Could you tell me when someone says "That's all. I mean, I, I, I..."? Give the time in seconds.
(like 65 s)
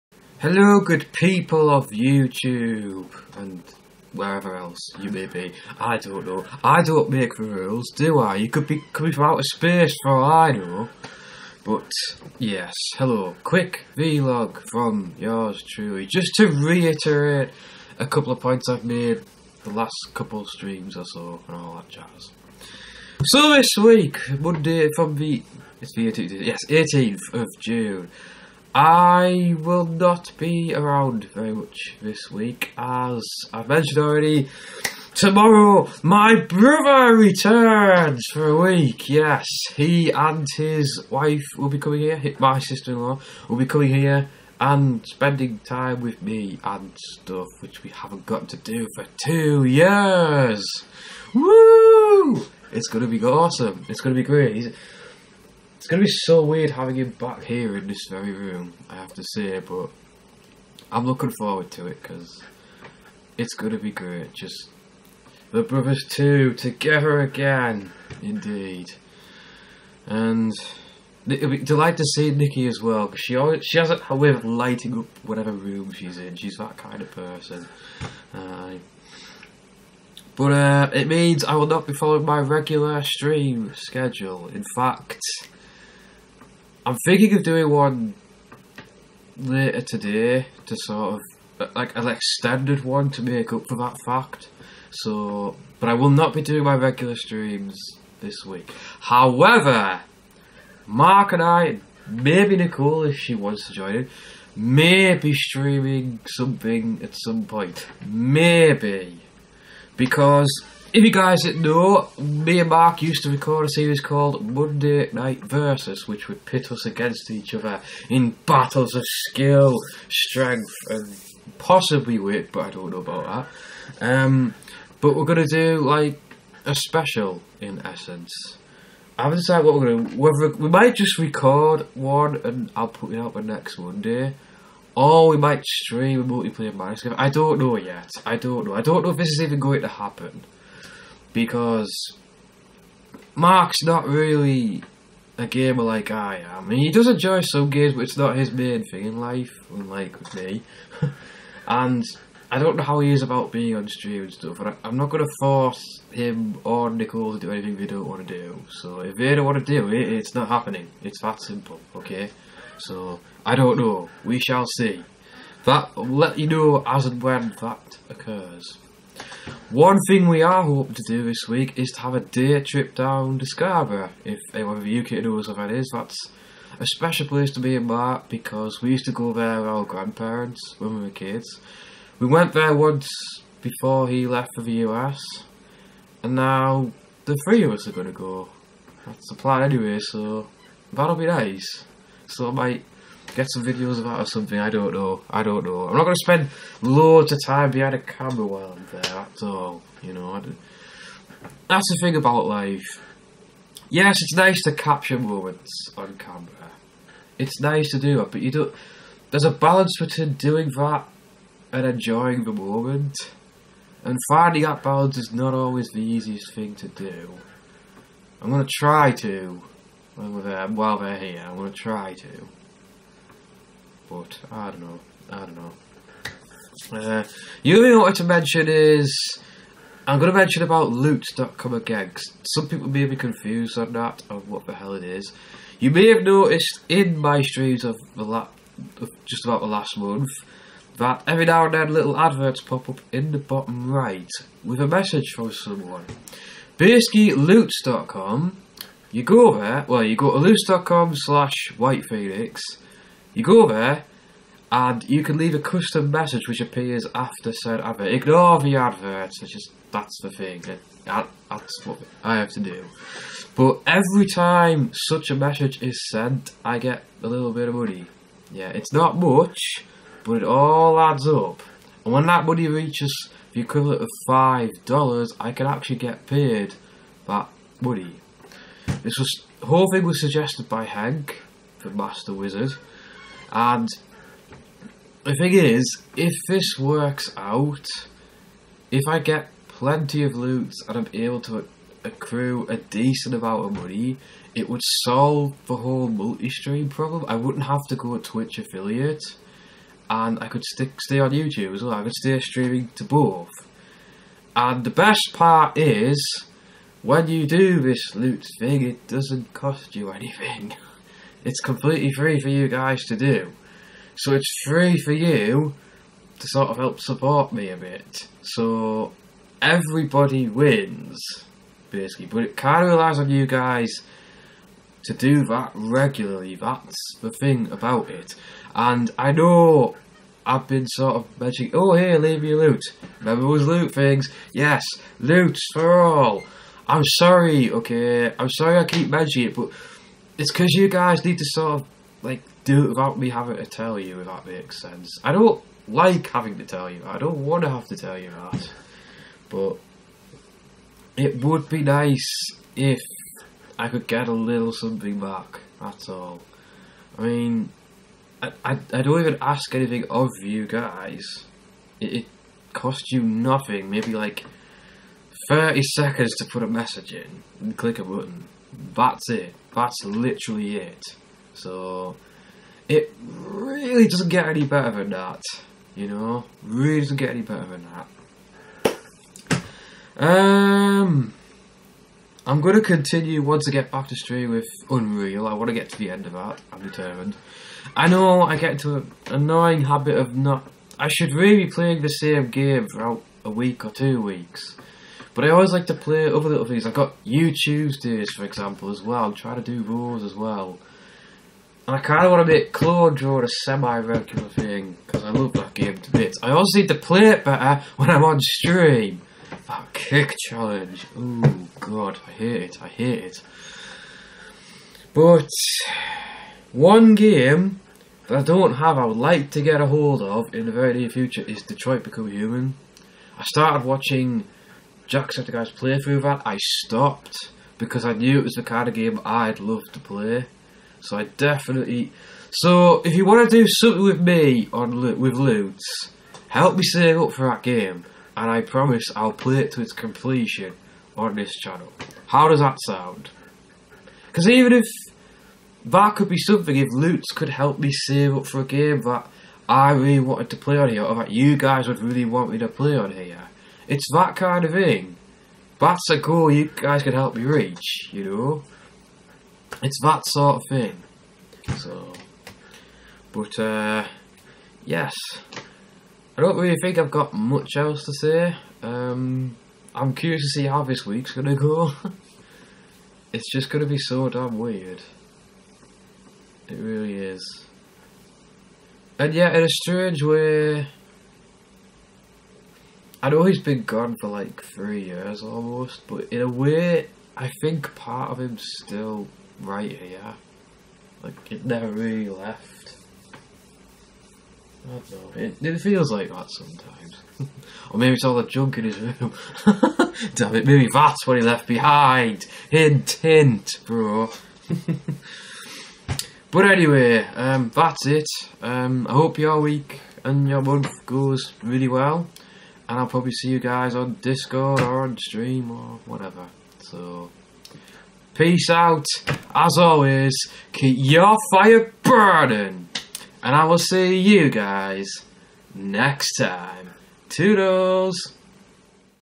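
355 s.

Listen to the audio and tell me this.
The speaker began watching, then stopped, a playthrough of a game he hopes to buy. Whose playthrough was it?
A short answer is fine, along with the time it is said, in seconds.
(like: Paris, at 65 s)
Jacksepticeye, at 425 s.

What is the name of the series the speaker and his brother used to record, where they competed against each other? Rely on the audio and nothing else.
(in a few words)
Monday Night Versus.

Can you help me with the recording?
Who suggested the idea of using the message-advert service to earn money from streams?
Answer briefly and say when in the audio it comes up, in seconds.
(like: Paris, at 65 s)
Hank, the Master Wizard, at 280 s.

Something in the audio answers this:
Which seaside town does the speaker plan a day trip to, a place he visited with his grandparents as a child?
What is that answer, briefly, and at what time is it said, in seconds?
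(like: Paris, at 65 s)
Scarborough, at 173 s.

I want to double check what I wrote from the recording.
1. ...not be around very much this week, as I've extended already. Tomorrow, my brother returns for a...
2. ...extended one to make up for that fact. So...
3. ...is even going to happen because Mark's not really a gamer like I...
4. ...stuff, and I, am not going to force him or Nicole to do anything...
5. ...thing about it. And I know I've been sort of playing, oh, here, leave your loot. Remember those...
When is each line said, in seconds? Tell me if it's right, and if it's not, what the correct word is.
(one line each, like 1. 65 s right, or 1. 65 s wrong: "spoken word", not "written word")
1. 29 s wrong: "mentioned", not "extended"
2. 92 s right
3. 139 s right
4. 154 s right
5. 327 s wrong: "mentioning", not "playing".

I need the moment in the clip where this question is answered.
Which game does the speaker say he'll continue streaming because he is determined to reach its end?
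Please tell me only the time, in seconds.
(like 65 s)
384 s.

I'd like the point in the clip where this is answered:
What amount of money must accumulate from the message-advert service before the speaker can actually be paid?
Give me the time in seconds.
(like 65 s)
274 s.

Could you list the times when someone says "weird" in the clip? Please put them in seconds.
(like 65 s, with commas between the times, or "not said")
56 s, 474 s.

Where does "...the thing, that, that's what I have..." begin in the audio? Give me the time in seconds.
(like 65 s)
260 s.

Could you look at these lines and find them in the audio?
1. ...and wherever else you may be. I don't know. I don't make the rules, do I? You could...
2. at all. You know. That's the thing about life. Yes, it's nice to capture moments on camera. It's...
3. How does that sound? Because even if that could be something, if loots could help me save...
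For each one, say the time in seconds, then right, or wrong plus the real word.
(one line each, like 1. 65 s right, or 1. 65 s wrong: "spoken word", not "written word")
1. 3 s right
2. 199 s right
3. 442 s right.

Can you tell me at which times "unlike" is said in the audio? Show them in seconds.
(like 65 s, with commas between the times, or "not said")
149 s.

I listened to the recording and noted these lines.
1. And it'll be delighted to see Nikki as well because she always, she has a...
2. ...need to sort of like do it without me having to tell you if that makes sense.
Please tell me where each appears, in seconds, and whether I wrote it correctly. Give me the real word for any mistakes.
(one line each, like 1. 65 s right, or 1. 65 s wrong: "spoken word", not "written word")
1. 70 s right
2. 341 s right.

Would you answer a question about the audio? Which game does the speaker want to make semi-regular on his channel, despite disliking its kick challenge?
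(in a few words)
Clone Drone.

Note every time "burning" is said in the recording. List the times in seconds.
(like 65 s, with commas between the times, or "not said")
522 s.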